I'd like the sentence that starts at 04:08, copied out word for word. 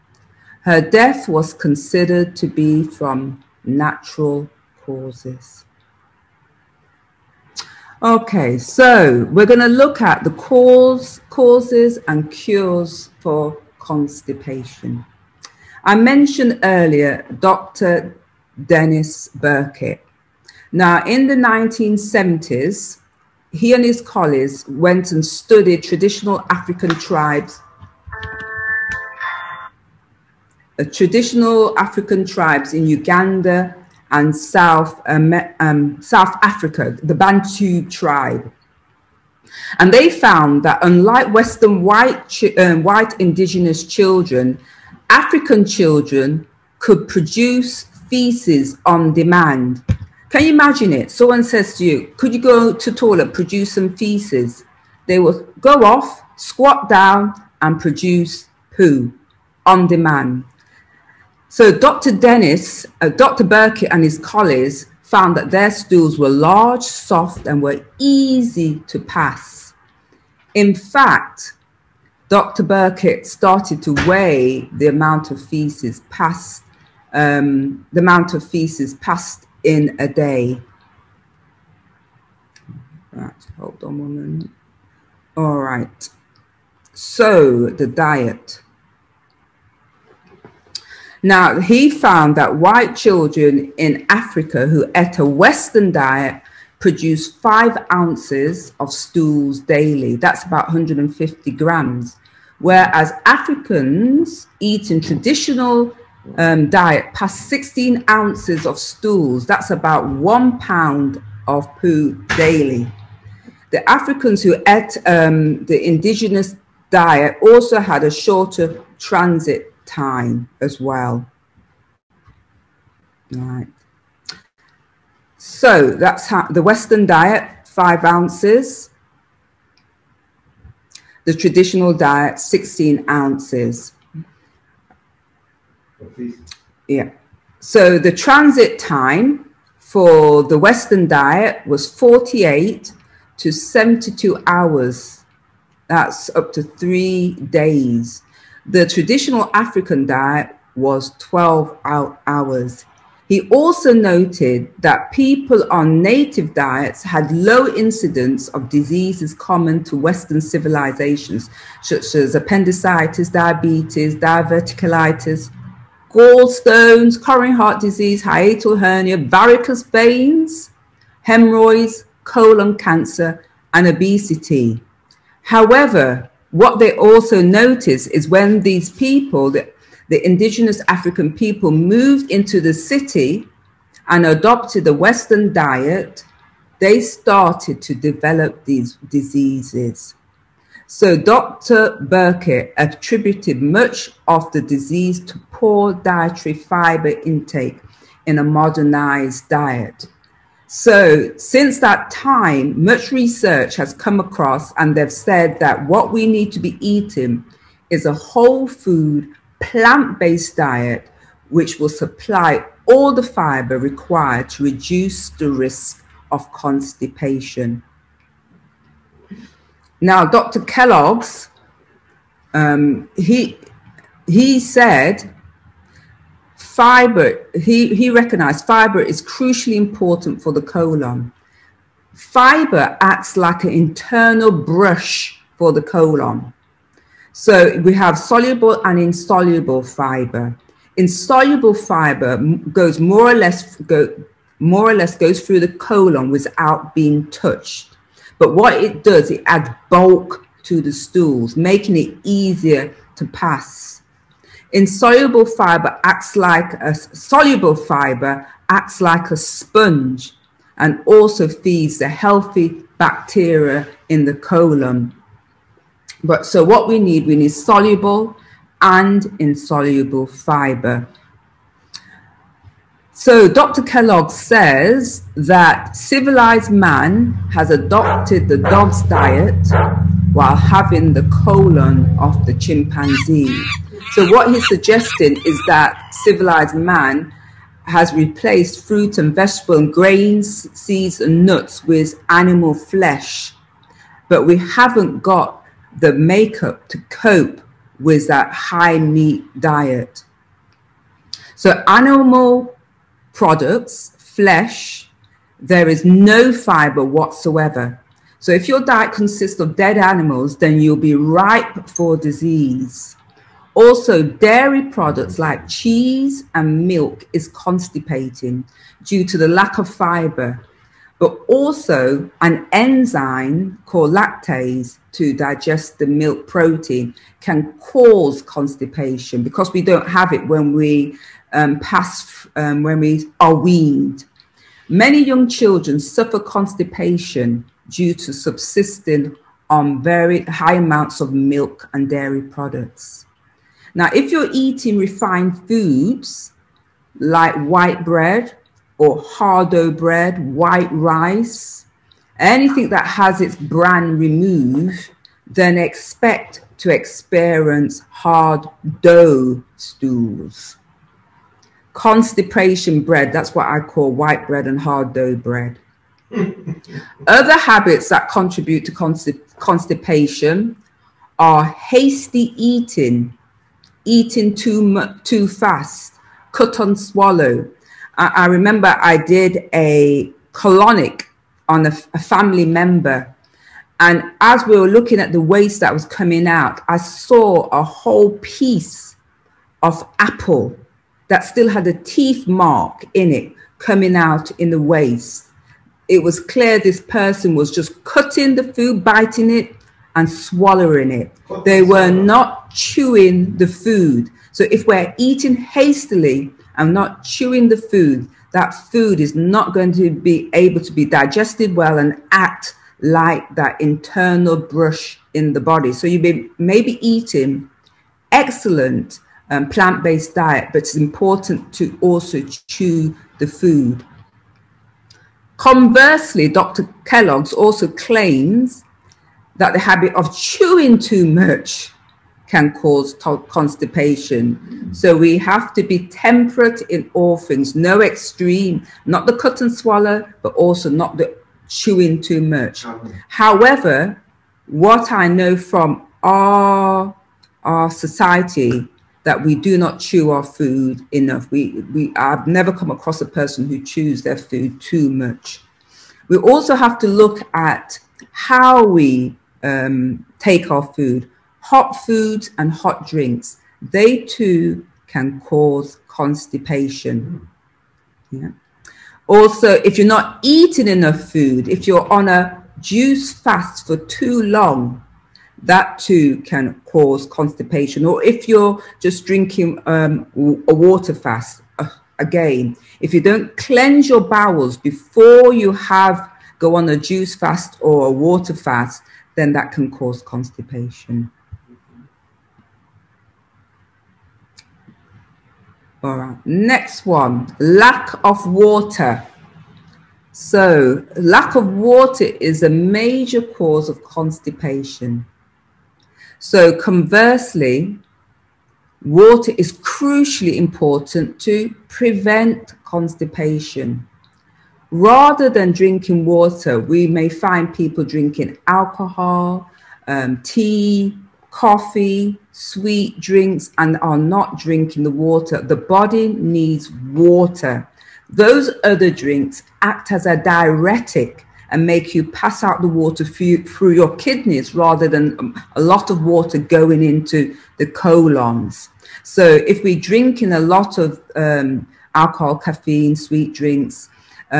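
But what it does, it adds bulk to the stools, making it easier to pass.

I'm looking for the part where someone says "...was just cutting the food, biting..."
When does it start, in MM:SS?
06:37.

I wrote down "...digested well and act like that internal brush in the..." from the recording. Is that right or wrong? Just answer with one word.
right.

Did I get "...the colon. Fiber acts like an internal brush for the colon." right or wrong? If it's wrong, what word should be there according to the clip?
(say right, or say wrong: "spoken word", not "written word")
right.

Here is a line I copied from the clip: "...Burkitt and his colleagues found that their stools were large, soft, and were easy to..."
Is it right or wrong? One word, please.
right.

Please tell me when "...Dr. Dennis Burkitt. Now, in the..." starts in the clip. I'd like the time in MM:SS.
00:17.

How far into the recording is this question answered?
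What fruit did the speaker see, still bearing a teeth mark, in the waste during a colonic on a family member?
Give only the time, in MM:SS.
06:30.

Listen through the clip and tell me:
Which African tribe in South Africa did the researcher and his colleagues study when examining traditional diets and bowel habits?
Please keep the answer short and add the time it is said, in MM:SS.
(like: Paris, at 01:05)
Bantu, at 00:37.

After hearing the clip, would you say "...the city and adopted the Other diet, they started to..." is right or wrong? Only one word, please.
wrong.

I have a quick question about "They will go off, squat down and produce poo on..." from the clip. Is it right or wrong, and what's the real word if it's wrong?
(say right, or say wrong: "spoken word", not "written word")
right.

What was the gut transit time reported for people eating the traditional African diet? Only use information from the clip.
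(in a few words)
12 hours.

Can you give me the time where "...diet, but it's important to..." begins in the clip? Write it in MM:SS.
07:00.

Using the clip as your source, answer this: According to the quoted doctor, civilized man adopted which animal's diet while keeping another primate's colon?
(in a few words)
dog.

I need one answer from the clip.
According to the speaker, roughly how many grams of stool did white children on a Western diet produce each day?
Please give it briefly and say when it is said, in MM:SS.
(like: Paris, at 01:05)
150 grams, at 01:40.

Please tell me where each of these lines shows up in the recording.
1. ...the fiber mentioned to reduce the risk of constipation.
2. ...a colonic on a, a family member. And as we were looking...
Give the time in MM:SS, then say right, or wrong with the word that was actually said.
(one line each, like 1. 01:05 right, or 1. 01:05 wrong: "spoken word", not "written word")
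1. 03:33 wrong: "required", not "mentioned"
2. 06:19 right.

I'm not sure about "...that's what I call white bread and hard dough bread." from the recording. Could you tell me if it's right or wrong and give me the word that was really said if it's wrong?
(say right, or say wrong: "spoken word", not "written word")
right.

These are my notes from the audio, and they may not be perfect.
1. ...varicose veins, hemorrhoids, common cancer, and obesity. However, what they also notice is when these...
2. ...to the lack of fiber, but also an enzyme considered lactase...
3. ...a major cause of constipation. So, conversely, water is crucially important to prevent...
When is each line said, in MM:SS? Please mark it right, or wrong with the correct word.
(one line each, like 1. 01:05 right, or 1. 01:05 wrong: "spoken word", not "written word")
1. 02:49 wrong: "colon", not "common"
2. 05:19 wrong: "called", not "considered"
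3. 08:22 right.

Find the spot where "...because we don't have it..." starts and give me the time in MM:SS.
05:29.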